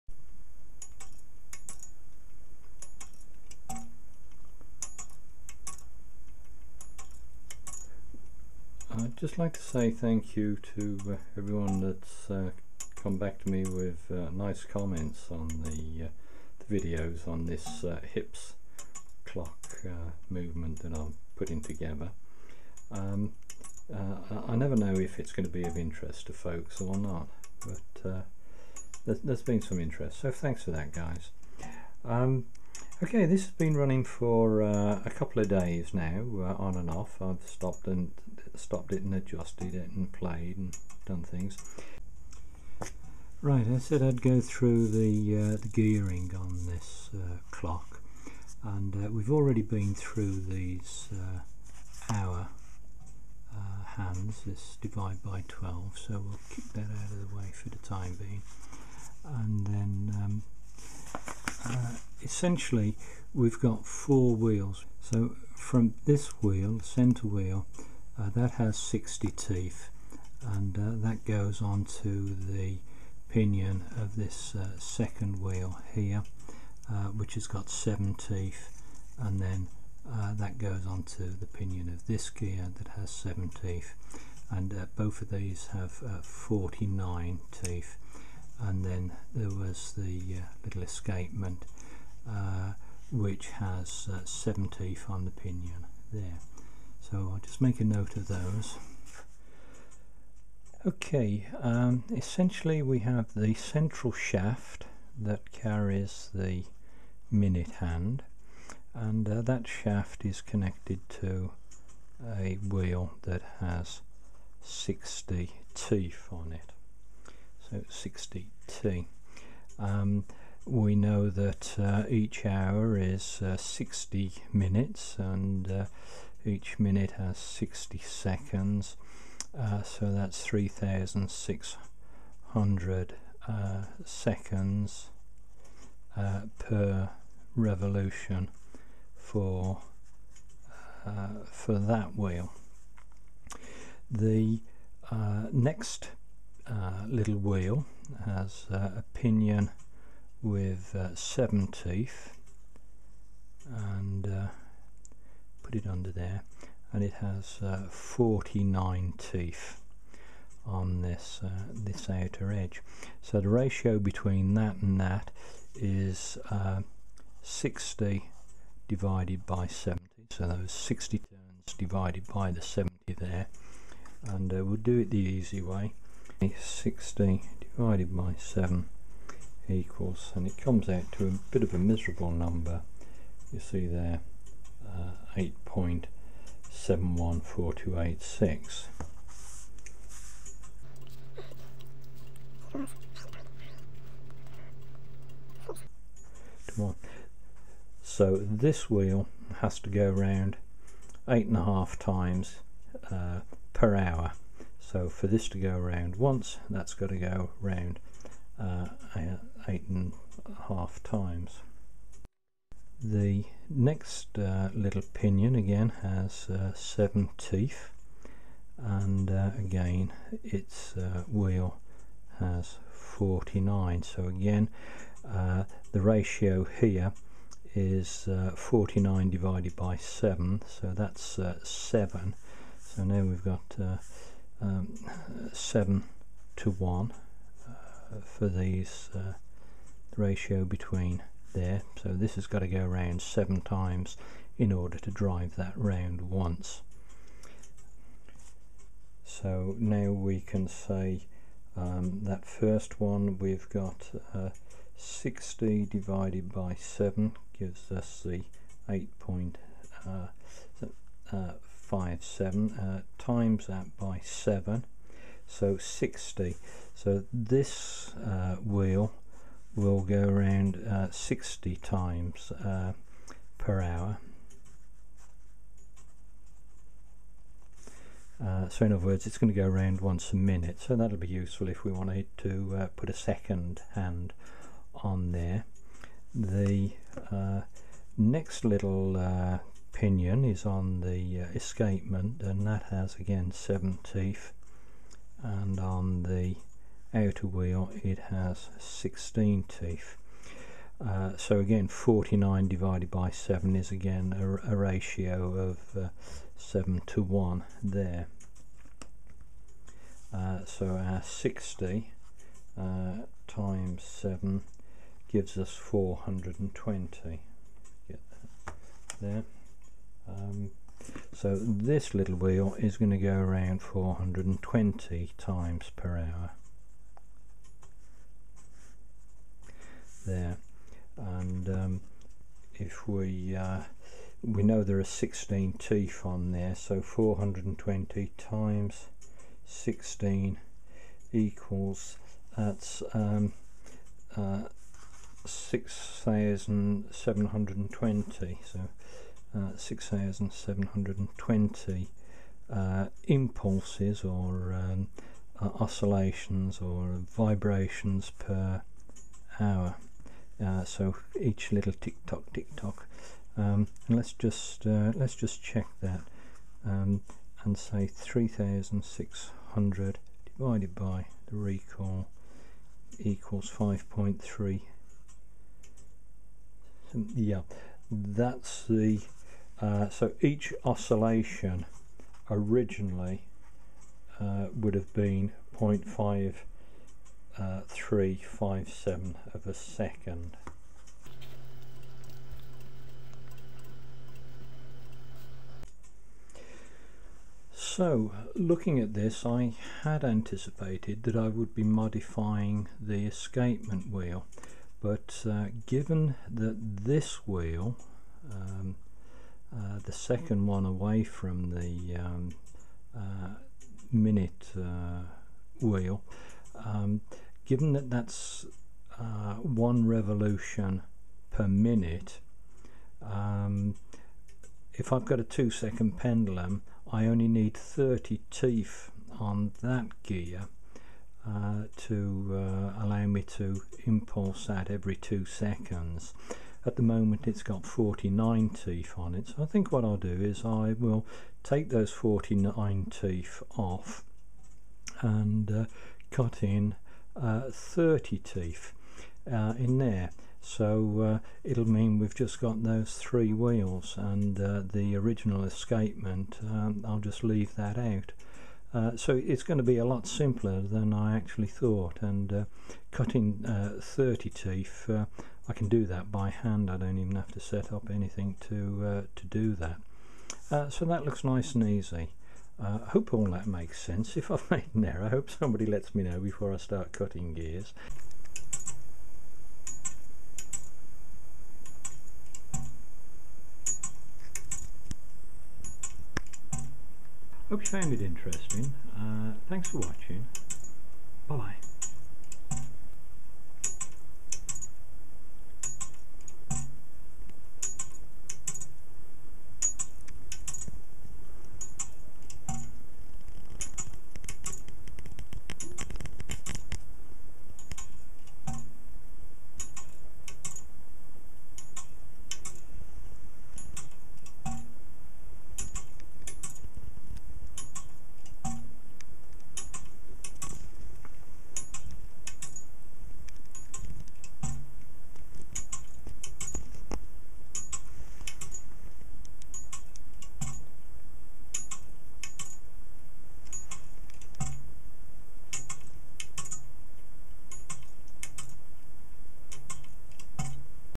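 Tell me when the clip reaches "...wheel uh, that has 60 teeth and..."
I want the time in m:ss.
1:07.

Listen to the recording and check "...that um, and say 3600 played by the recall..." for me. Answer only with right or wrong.
wrong.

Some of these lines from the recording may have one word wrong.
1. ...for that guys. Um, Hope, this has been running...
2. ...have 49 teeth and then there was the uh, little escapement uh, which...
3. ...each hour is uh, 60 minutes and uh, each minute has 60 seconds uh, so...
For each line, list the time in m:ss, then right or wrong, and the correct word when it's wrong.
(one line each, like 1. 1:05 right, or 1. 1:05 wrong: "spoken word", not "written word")
1. 0:30 wrong: "Okay", not "Hope"
2. 1:25 right
3. 2:02 right.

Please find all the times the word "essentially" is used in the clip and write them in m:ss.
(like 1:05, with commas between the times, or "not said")
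1:02, 1:42.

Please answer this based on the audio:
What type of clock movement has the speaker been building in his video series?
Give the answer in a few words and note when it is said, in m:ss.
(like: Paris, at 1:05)
Hipps, at 0:18.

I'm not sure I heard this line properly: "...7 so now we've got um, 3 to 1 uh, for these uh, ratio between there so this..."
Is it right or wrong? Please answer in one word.
wrong.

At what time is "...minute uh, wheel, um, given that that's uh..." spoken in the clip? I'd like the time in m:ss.
6:54.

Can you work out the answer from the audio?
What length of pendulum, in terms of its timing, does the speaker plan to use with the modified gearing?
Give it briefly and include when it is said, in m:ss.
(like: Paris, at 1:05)
two second, at 7:05.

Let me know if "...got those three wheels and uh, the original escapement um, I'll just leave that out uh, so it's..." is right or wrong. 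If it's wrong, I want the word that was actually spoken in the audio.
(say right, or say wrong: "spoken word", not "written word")
right.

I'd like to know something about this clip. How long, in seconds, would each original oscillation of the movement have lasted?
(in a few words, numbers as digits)
0.5357.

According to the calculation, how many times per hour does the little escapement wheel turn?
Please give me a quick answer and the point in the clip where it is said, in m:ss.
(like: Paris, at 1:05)
420, at 5:23.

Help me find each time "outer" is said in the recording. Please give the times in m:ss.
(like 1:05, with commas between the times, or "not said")
2:42, 4:57.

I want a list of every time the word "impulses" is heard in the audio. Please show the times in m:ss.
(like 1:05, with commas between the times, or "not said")
5:53, 7:14.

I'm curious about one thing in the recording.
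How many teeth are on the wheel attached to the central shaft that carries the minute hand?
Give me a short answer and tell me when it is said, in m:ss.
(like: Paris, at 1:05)
60, at 1:58.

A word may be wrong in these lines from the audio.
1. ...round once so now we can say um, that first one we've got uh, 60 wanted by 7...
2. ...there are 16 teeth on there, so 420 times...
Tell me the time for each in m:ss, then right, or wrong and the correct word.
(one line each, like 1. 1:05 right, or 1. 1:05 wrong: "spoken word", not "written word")
1. 4:05 wrong: "divided", not "wanted"
2. 5:34 right.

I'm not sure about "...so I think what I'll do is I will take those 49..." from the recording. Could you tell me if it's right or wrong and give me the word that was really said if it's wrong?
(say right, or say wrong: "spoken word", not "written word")
right.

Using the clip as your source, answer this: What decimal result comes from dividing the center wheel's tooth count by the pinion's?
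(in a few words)
8.714286.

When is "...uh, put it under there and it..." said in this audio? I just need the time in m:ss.
2:34.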